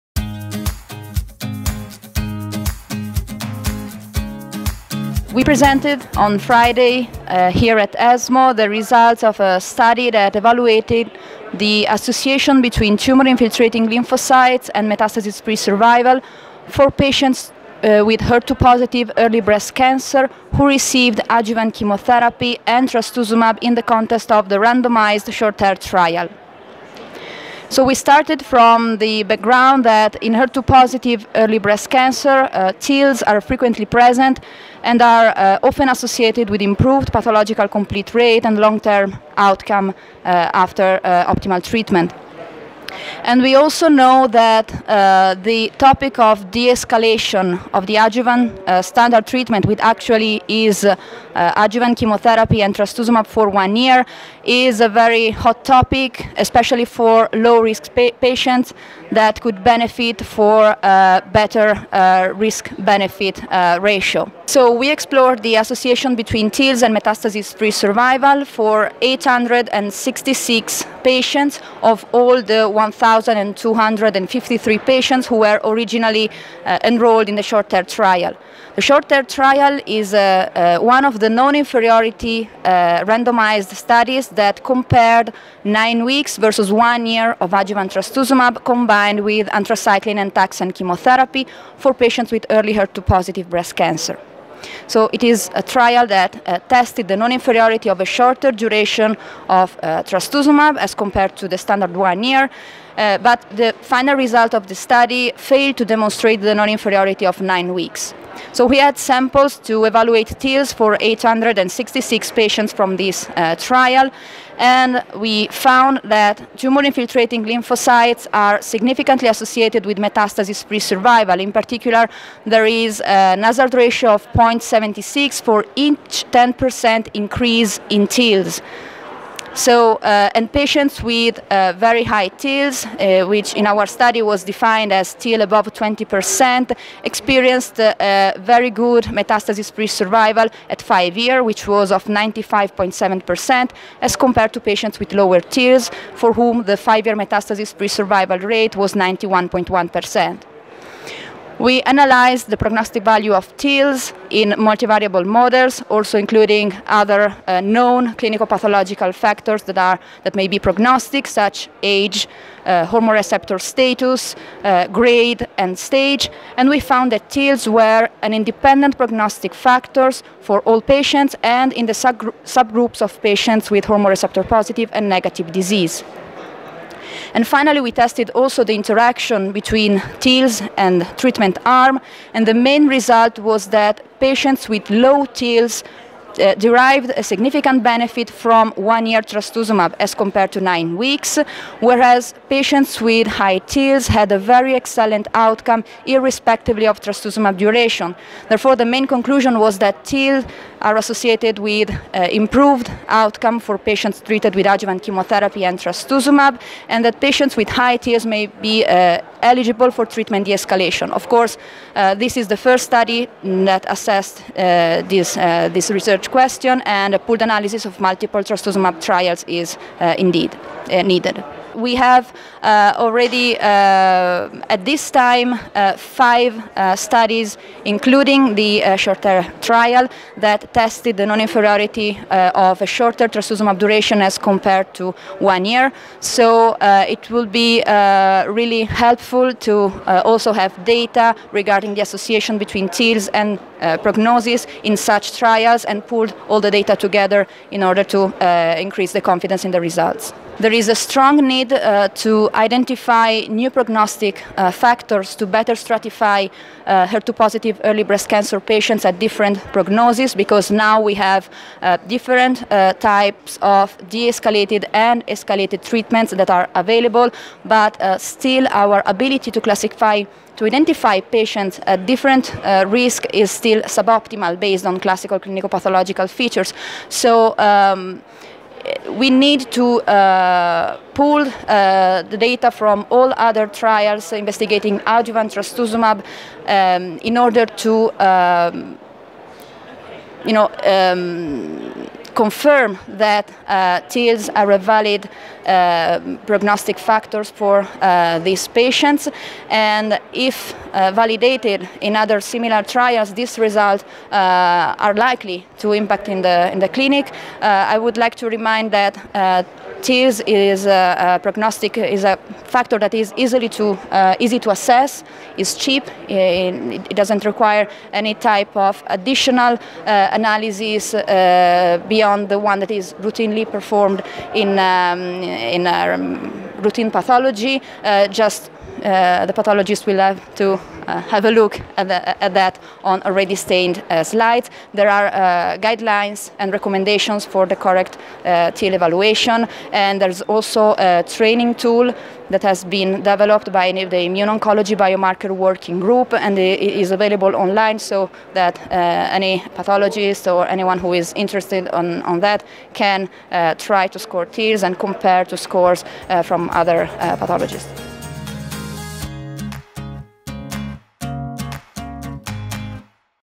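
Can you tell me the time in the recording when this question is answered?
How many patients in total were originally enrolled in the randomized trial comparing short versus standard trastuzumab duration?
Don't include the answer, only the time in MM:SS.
01:12.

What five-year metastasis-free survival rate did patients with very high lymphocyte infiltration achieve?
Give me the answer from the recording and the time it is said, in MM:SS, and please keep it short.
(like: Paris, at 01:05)
95.7%, at 02:22.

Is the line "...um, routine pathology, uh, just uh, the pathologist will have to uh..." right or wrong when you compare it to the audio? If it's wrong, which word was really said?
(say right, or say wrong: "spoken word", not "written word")
right.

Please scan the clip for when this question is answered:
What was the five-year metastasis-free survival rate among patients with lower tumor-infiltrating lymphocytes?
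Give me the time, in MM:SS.
02:28.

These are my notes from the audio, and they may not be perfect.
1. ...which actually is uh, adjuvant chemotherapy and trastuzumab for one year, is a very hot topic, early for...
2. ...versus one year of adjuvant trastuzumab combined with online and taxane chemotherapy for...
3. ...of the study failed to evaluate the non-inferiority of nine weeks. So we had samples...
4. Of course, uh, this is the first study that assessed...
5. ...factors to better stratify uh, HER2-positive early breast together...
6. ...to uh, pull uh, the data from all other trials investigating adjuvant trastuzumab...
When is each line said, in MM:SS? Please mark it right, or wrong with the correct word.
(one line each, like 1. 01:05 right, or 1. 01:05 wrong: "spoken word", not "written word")
1. 00:49 wrong: "especially", not "early"
2. 01:26 wrong: "anthracycline", not "online"
3. 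01:44 wrong: "demonstrate", not "evaluate"
4. 03:31 right
5. 04:14 wrong: "cancer", not "together"
6. 04:39 right.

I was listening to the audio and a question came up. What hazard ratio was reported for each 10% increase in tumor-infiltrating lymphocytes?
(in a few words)
0.76.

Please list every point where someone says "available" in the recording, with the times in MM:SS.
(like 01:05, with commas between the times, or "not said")
04:26, 05:47.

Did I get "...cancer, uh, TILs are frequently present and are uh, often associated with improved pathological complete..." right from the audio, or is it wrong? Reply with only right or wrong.
right.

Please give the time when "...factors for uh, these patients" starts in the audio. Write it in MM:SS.
04:56.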